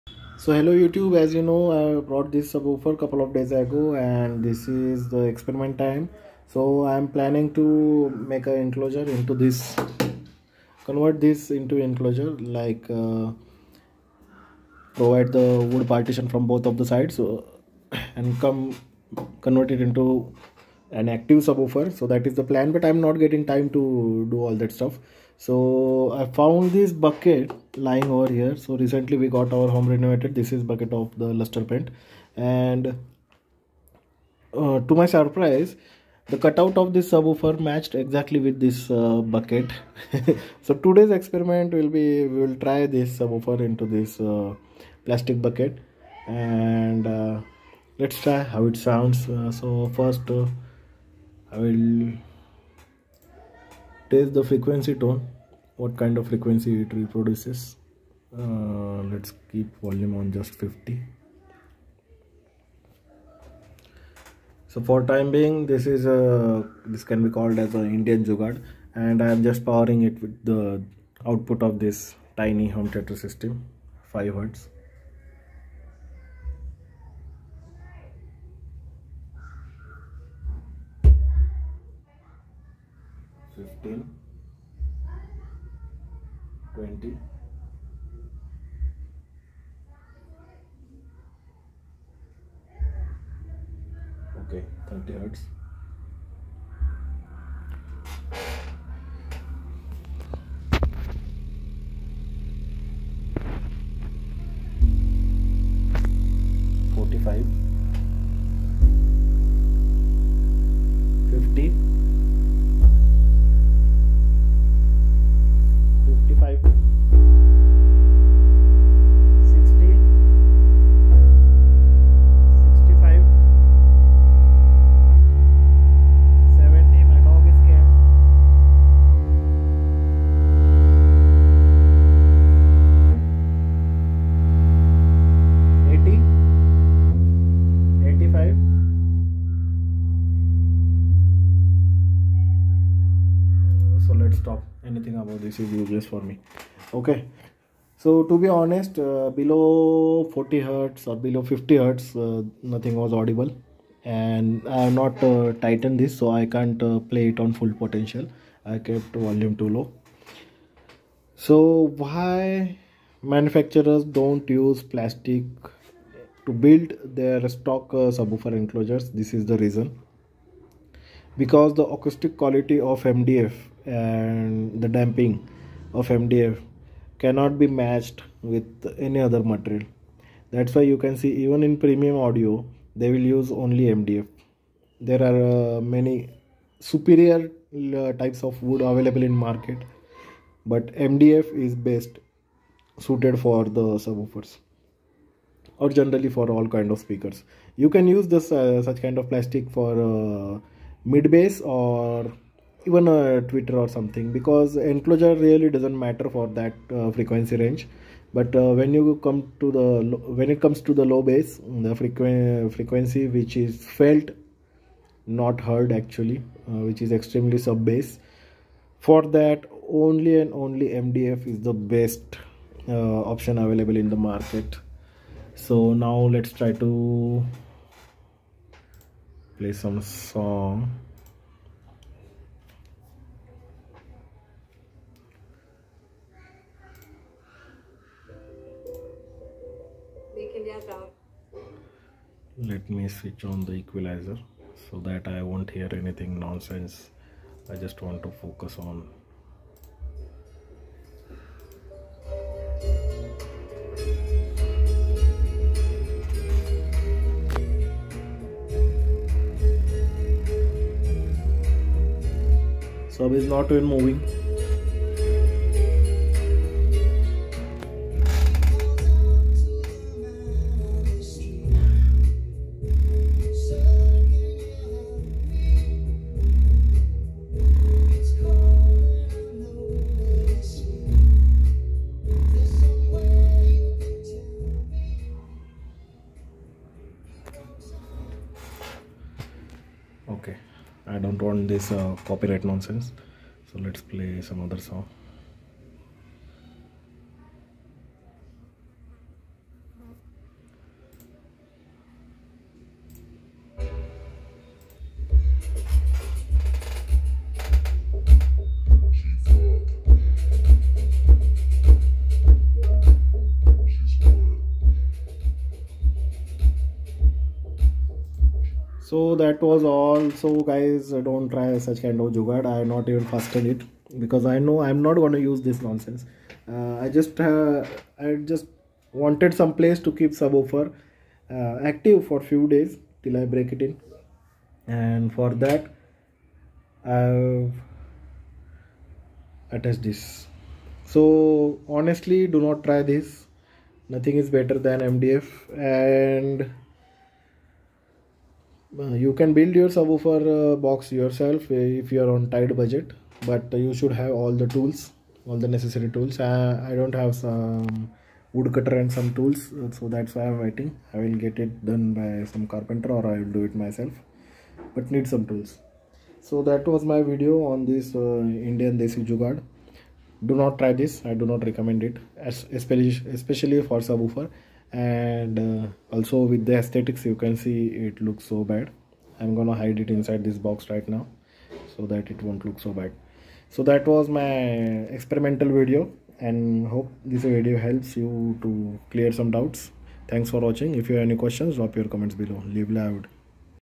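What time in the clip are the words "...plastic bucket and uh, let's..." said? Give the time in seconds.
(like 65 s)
45 s.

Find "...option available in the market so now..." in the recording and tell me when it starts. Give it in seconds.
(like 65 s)
223 s.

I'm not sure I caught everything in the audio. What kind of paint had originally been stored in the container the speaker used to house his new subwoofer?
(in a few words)
luster paint.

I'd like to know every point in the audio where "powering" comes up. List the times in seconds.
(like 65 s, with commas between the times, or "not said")
69 s.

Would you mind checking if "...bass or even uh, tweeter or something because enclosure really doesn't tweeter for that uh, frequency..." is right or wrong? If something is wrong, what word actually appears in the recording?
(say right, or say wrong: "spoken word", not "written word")
wrong: "matter", not "tweeter".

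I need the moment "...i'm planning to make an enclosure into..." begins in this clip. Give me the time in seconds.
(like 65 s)
6 s.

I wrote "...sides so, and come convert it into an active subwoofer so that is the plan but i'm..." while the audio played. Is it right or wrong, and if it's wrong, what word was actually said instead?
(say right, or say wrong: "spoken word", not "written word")
right.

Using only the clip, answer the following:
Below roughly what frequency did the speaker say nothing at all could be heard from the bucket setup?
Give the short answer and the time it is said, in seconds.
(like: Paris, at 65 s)
40 hertz, at 150 s.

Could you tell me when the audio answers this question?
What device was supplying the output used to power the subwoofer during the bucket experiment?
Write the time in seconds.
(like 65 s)
72 s.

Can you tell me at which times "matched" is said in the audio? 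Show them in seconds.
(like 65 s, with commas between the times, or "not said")
37 s, 177 s.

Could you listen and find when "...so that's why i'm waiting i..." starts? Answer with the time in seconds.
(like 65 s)
359 s.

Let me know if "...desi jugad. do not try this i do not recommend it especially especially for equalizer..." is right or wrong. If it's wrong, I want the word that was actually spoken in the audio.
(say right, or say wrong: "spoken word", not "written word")
wrong: "subwoofer", not "equalizer".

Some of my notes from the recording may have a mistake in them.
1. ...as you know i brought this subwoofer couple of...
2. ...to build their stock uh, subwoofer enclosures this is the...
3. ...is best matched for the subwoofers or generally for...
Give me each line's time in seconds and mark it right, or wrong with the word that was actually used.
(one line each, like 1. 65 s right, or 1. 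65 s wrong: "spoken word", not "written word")
1. 1 s right
2. 166 s right
3. 191 s wrong: "suited", not "matched".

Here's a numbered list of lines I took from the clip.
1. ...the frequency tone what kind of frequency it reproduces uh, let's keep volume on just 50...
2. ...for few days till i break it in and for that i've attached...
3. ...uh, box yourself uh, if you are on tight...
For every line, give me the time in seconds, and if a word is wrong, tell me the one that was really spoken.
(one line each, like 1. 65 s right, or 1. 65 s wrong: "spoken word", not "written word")
1. 54 s right
2. 332 s right
3. 350 s right.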